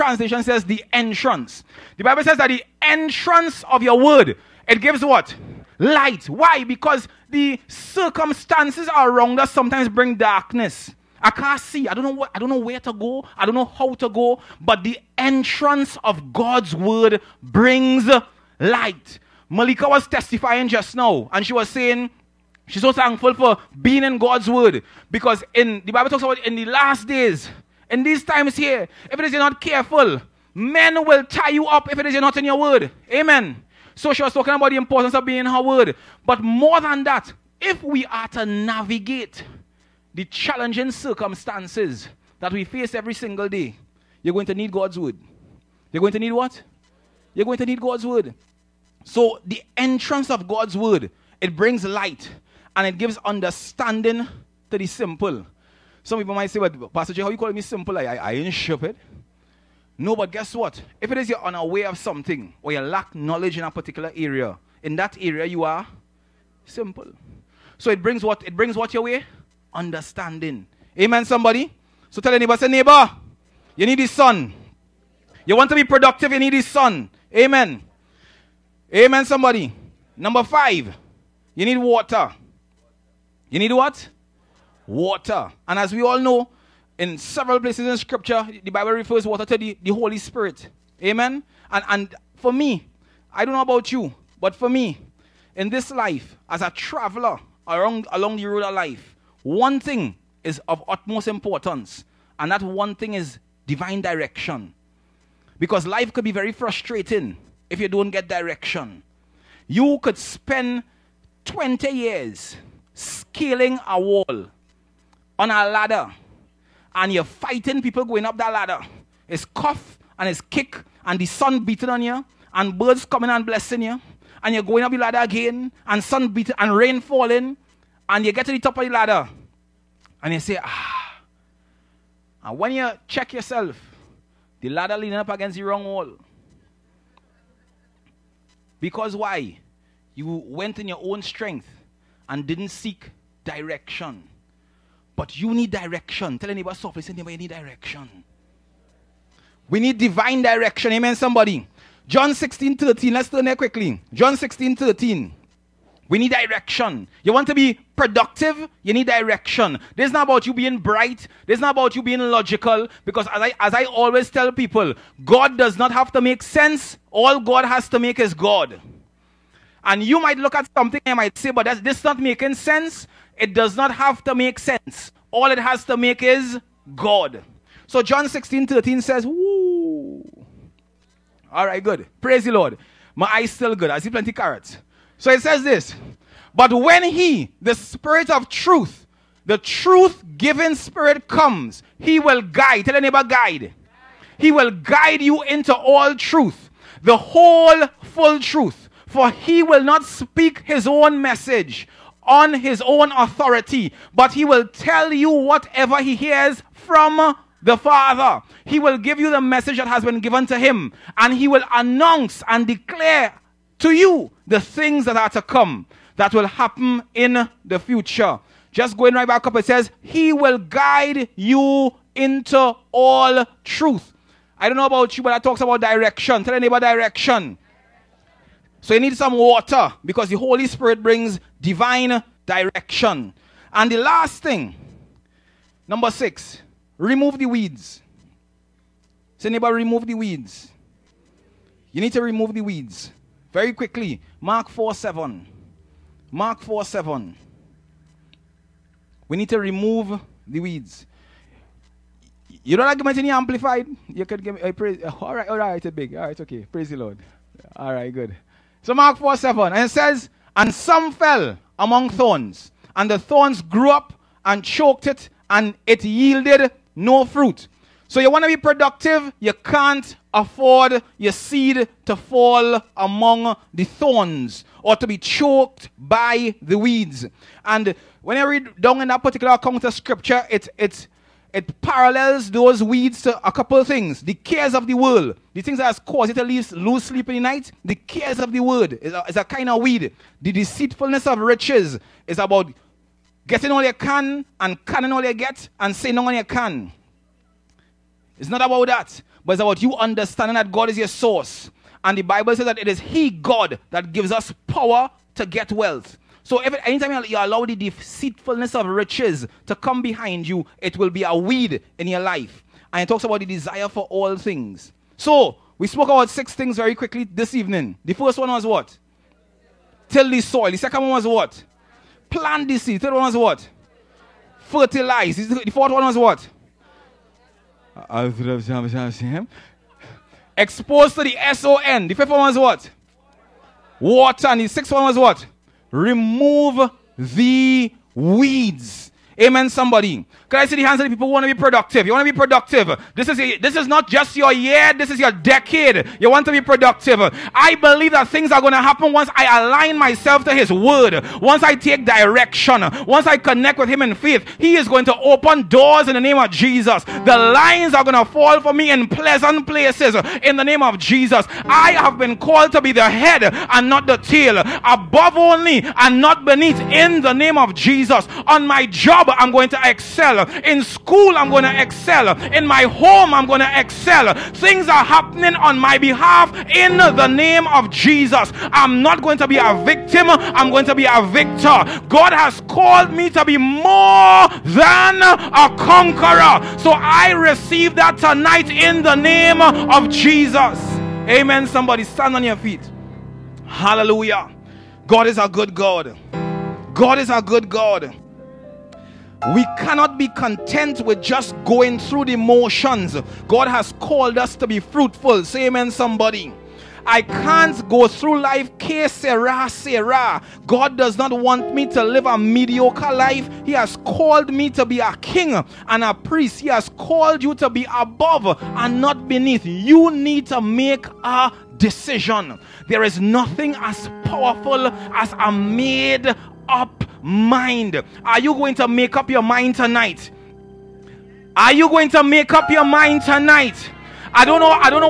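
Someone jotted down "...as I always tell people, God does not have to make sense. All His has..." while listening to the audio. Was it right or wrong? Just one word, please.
wrong.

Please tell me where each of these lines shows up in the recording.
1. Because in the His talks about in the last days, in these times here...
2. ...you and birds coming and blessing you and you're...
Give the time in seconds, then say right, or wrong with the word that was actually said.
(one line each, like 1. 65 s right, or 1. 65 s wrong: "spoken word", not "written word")
1. 25 s wrong: "Bible", not "His"
2. 122 s right.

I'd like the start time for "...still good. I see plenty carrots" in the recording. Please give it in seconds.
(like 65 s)
183 s.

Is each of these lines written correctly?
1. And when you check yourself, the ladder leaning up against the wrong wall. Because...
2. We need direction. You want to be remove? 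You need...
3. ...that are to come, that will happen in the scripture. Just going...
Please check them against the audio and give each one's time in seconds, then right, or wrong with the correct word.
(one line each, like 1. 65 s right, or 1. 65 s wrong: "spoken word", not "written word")
1. 132 s right
2. 156 s wrong: "productive", not "remove"
3. 215 s wrong: "future", not "scripture".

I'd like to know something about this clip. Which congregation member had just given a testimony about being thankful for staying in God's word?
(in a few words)
Malika.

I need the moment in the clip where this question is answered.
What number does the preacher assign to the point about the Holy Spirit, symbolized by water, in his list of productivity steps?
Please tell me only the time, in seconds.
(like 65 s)
80 s.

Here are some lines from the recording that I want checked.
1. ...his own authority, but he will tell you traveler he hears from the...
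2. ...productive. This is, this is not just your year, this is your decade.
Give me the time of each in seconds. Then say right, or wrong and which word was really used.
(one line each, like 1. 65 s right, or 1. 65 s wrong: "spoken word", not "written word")
1. 202 s wrong: "whatever", not "traveler"
2. 342 s right.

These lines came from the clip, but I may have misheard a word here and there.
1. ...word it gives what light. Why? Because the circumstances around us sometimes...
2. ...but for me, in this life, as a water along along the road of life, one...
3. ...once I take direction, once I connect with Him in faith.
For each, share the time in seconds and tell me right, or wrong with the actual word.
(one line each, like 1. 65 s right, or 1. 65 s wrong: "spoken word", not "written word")
1. 3 s right
2. 94 s wrong: "traveler", not "water"
3. 351 s right.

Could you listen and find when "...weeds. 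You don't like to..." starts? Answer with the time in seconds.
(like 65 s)
250 s.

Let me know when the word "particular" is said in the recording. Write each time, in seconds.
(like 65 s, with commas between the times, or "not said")
63 s, 279 s.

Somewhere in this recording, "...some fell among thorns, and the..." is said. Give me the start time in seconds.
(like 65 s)
260 s.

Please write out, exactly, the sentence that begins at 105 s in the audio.
Because life could be very frustrating if you don't get direction.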